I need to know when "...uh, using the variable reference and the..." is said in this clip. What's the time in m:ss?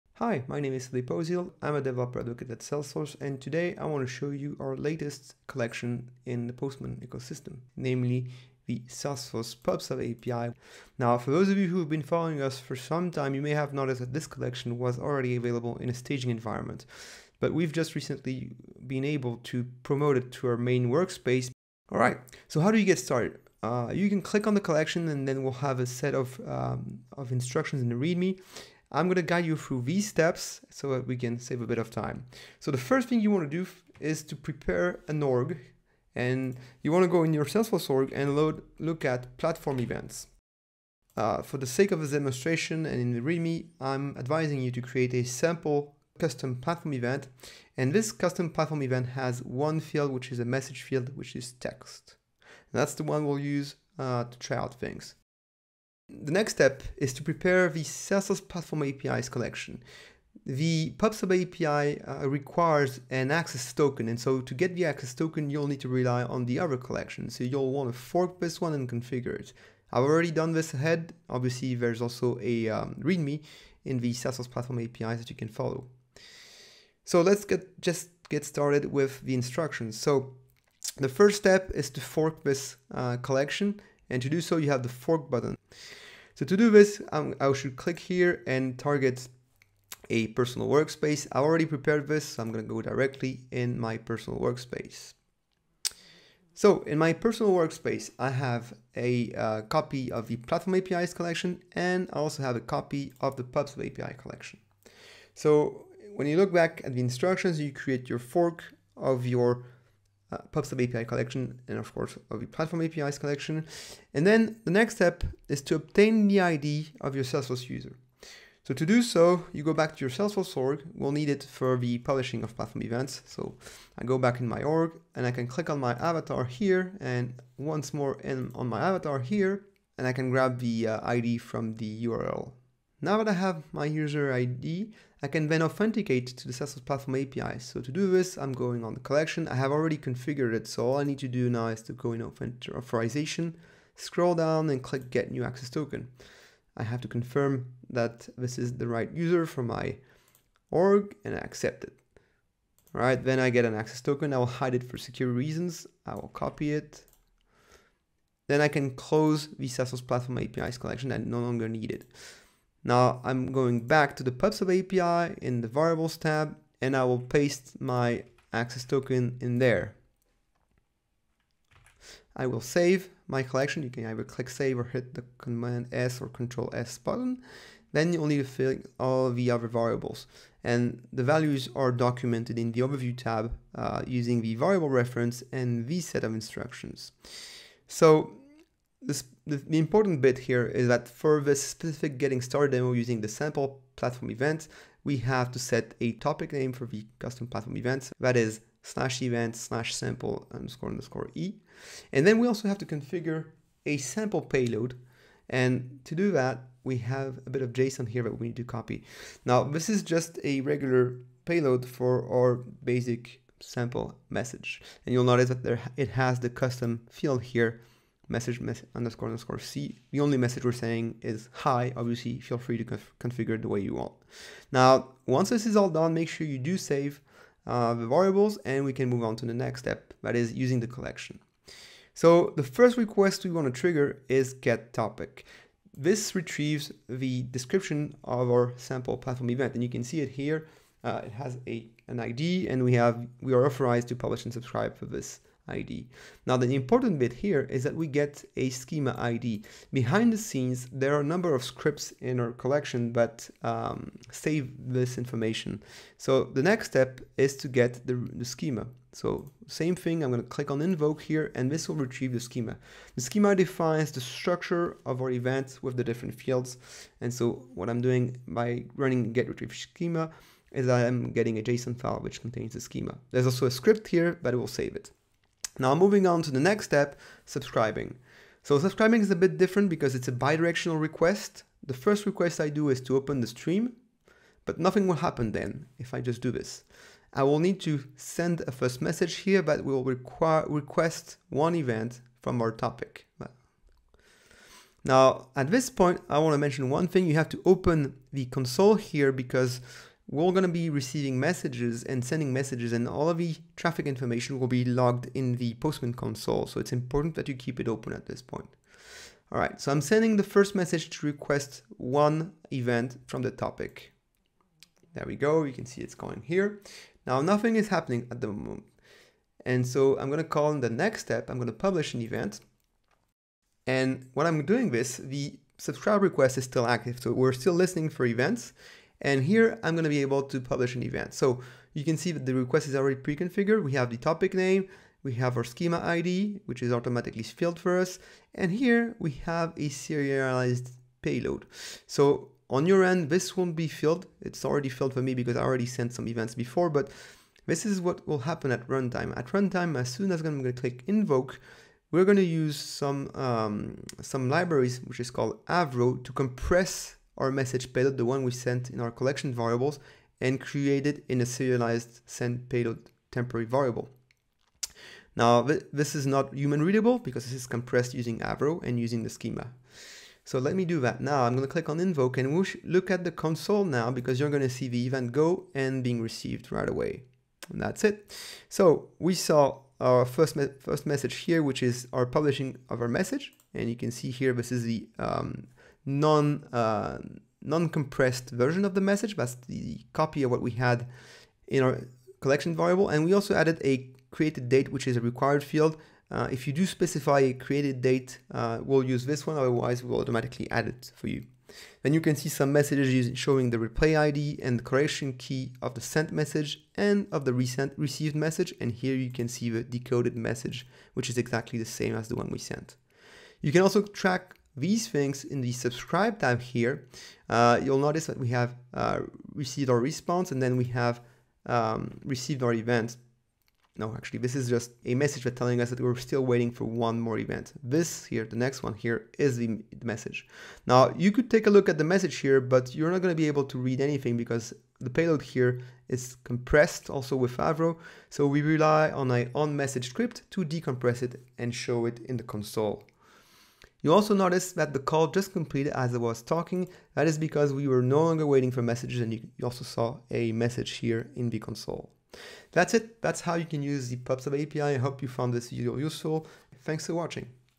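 3:03.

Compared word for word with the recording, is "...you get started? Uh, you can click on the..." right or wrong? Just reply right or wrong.
right.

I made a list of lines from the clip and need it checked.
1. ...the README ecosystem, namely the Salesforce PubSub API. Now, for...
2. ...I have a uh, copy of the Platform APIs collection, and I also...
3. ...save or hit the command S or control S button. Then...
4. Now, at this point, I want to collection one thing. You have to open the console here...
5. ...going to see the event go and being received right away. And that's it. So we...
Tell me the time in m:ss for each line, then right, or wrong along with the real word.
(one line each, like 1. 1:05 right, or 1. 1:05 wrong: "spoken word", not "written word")
1. 0:06 wrong: "Postman", not "README"
2. 1:38 right
3. 2:54 right
4. 4:55 wrong: "mention", not "collection"
5. 6:14 right.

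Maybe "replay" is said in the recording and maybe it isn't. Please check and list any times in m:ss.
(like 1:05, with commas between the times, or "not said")
6:43.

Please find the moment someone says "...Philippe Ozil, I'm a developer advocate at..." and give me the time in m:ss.
0:00.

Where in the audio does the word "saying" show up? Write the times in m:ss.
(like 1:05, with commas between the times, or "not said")
3:40.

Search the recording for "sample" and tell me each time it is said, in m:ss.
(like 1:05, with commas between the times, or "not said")
0:45, 3:13, 3:19, 3:23, 3:33, 3:58.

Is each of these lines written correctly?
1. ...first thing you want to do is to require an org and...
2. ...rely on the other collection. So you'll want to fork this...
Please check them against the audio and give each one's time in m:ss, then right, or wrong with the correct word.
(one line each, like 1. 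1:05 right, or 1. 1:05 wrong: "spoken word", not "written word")
1. 0:32 wrong: "prepare", not "require"
2. 1:05 right.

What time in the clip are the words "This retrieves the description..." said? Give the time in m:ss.
3:55.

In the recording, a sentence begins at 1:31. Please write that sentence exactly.
I already prepared this, so I'm gonna go directly in my personal workspace.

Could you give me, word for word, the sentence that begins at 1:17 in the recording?
So let's get just get started with the instructions.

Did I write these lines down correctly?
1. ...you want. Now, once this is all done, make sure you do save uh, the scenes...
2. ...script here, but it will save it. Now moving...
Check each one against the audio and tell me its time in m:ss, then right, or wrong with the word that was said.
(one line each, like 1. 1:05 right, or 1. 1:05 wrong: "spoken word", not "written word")
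1. 3:43 wrong: "variables", not "scenes"
2. 4:33 right.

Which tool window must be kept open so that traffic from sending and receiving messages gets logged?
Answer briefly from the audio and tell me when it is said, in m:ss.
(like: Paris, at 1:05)
Postman console, at 5:05.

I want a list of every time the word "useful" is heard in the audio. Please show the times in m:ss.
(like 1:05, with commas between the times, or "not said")
7:35.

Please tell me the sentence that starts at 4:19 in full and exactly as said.
So same thing, I'm going to click on invoke here and this will retrieve the schema.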